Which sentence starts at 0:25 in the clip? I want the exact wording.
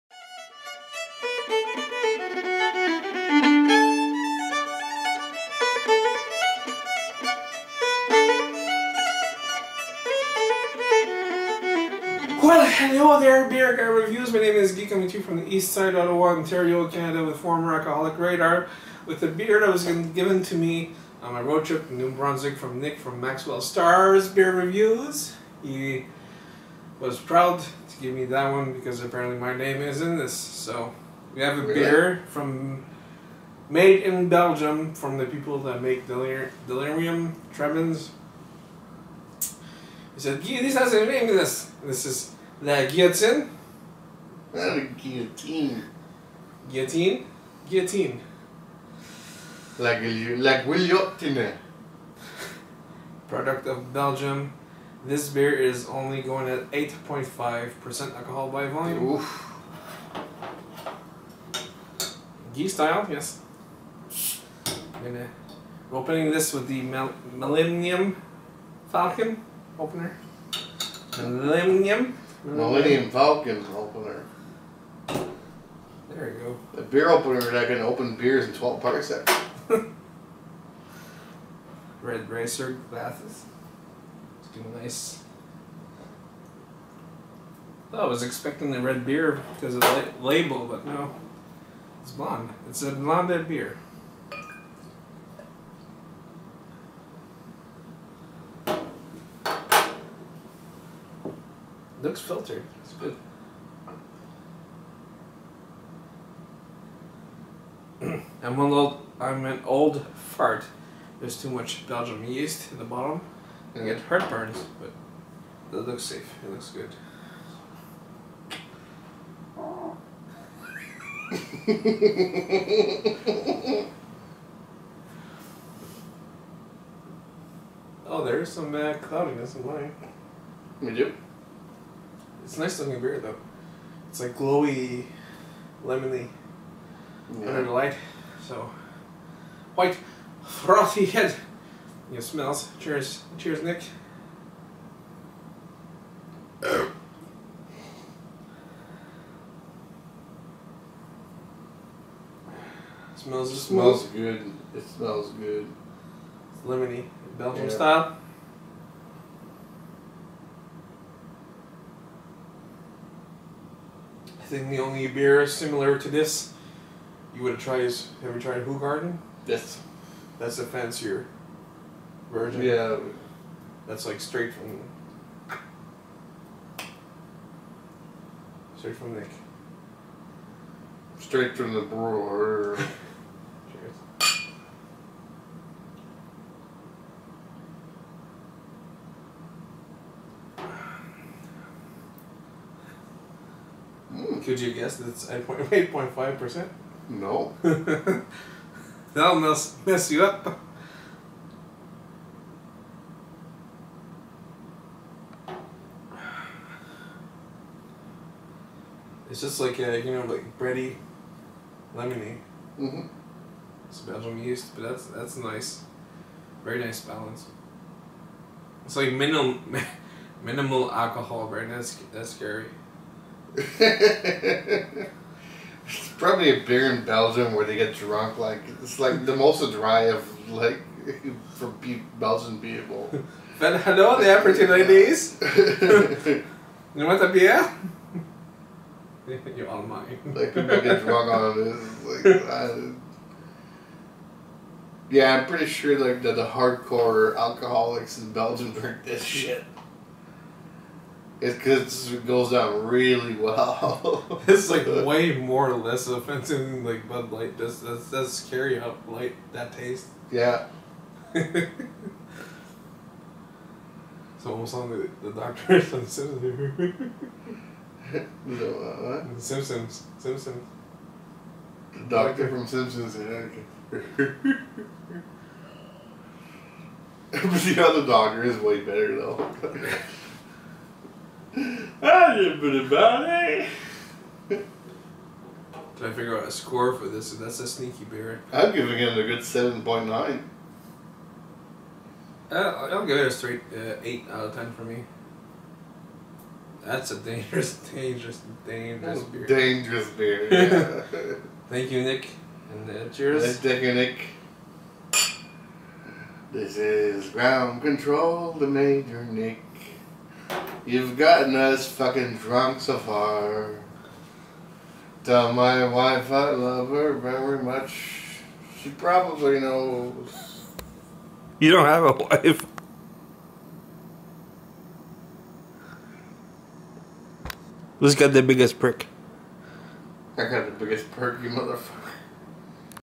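He was proud to give me that one because apparently my name is in this.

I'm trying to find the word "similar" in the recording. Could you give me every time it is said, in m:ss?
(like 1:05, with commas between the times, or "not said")
2:45.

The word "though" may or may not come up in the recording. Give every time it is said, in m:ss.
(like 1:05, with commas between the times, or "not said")
2:13, 4:39.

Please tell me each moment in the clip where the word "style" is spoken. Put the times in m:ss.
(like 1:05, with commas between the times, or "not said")
1:02, 2:37.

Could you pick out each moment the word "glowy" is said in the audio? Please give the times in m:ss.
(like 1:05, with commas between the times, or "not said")
2:14.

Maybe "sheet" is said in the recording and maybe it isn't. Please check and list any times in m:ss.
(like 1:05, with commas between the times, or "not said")
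not said.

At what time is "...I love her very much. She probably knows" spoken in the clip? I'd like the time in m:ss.
5:16.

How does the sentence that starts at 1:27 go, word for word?
Oh, I was expecting the red beer because of the label, but no.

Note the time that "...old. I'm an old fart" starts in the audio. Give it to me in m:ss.
1:48.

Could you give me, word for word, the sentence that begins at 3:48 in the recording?
Like it's like the most dry of like for be- Belgian people.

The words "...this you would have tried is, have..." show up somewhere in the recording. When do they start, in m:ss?
2:46.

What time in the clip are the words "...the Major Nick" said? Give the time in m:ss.
5:08.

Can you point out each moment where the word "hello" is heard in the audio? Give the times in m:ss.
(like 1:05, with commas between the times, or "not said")
0:12, 3:53.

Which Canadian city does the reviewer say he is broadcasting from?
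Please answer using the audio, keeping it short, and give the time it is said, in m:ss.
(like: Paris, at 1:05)
Ottawa, at 0:15.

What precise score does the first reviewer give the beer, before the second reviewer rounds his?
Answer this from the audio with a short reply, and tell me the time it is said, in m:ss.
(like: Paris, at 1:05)
7.9, at 4:49.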